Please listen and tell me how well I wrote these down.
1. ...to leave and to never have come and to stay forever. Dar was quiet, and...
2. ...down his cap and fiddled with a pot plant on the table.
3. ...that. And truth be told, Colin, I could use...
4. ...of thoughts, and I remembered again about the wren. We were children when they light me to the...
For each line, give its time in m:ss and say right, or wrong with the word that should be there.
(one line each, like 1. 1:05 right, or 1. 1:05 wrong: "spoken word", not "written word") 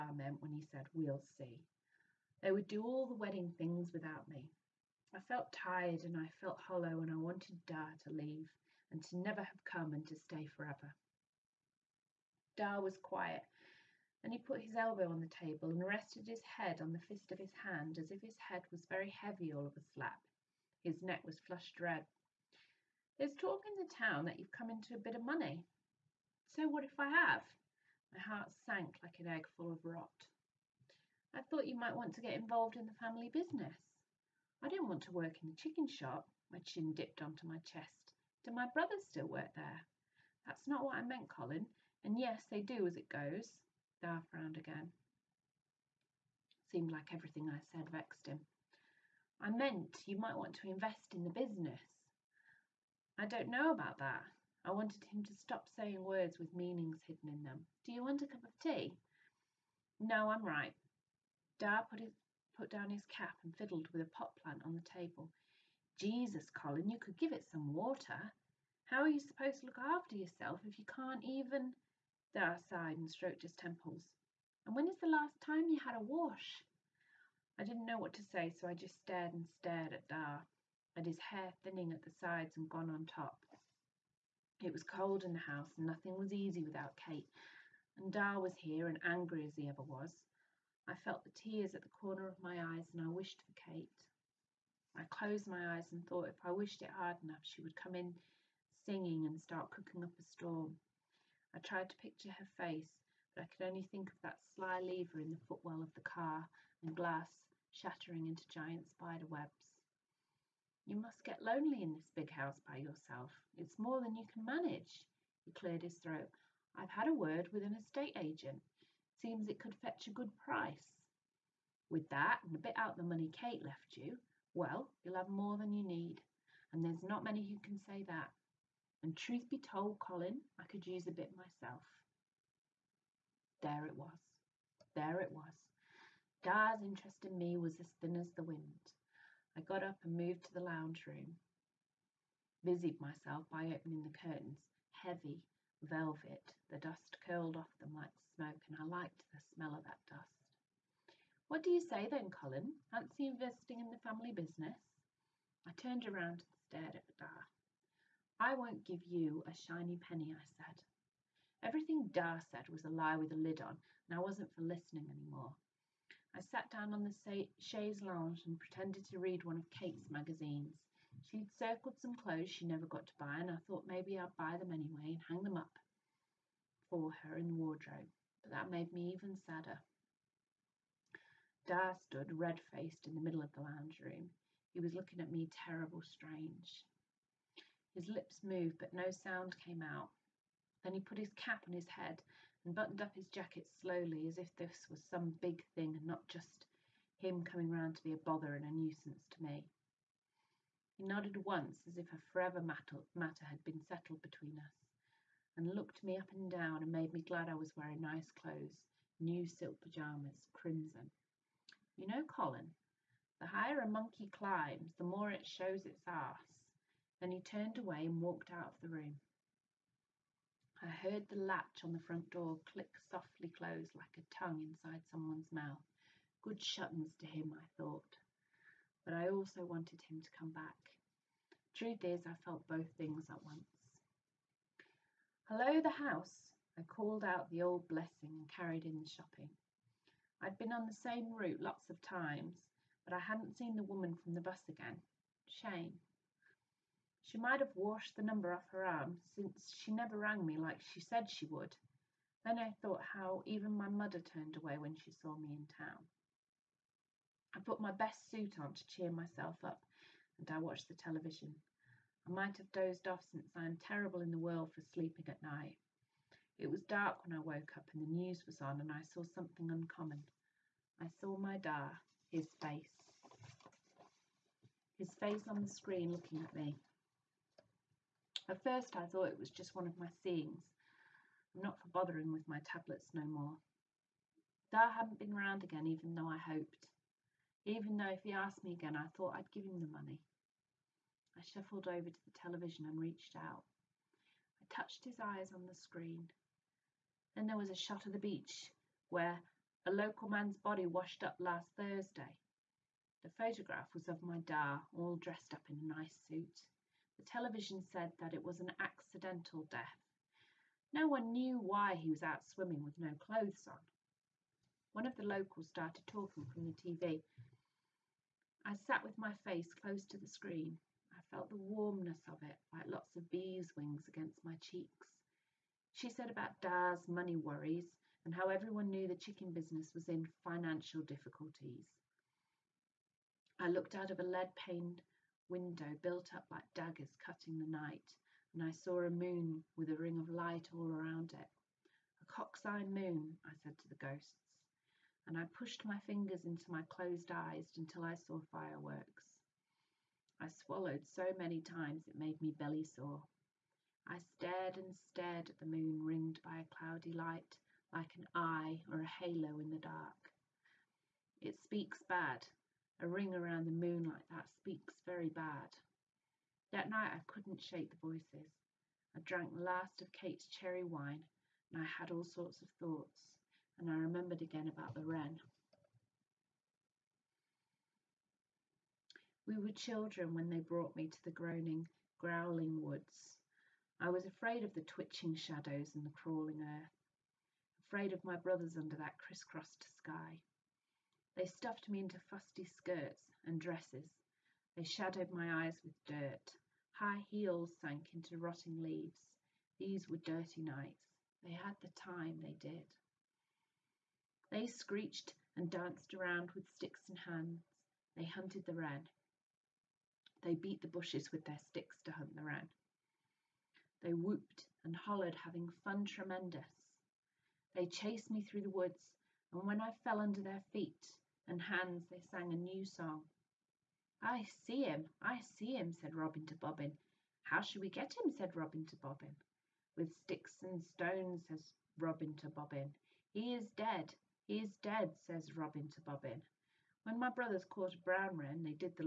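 1. 0:08 right
2. 1:02 right
3. 2:08 right
4. 6:12 wrong: "brought", not "light".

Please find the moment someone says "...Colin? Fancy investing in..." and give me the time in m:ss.
2:32.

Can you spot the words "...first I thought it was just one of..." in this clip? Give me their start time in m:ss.
4:38.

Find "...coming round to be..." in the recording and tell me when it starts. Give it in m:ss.
3:17.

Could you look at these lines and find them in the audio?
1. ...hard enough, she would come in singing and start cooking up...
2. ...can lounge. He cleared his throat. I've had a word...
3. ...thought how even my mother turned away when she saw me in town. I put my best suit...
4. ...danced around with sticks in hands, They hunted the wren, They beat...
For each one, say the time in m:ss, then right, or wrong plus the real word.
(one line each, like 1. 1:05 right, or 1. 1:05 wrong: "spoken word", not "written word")
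1. 1:36 right
2. 1:54 wrong: "manage", not "lounge"
3. 4:12 right
4. 6:45 right.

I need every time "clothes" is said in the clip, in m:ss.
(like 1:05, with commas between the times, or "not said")
2:52, 3:28, 5:13.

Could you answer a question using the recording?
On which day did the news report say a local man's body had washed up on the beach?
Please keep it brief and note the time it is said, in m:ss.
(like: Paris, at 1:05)
Thursday, at 5:01.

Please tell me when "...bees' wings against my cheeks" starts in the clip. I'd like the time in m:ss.
5:23.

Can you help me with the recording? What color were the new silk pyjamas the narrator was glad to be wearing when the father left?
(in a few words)
Crimson.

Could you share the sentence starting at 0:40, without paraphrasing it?
That's not what I meant, Colin.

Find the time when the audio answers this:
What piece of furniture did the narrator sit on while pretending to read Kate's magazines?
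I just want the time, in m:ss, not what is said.
2:47.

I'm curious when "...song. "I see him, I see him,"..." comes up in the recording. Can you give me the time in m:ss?
7:02.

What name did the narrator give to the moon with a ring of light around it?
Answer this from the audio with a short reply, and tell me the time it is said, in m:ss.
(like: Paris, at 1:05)
A cock's eye moon, at 5:42.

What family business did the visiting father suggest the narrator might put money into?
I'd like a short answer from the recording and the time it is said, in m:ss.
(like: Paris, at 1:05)
The chicken shop, at 0:35.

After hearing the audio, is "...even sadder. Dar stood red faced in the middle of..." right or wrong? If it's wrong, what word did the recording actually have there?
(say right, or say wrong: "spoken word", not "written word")
right.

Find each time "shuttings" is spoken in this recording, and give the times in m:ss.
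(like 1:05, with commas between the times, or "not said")
3:46.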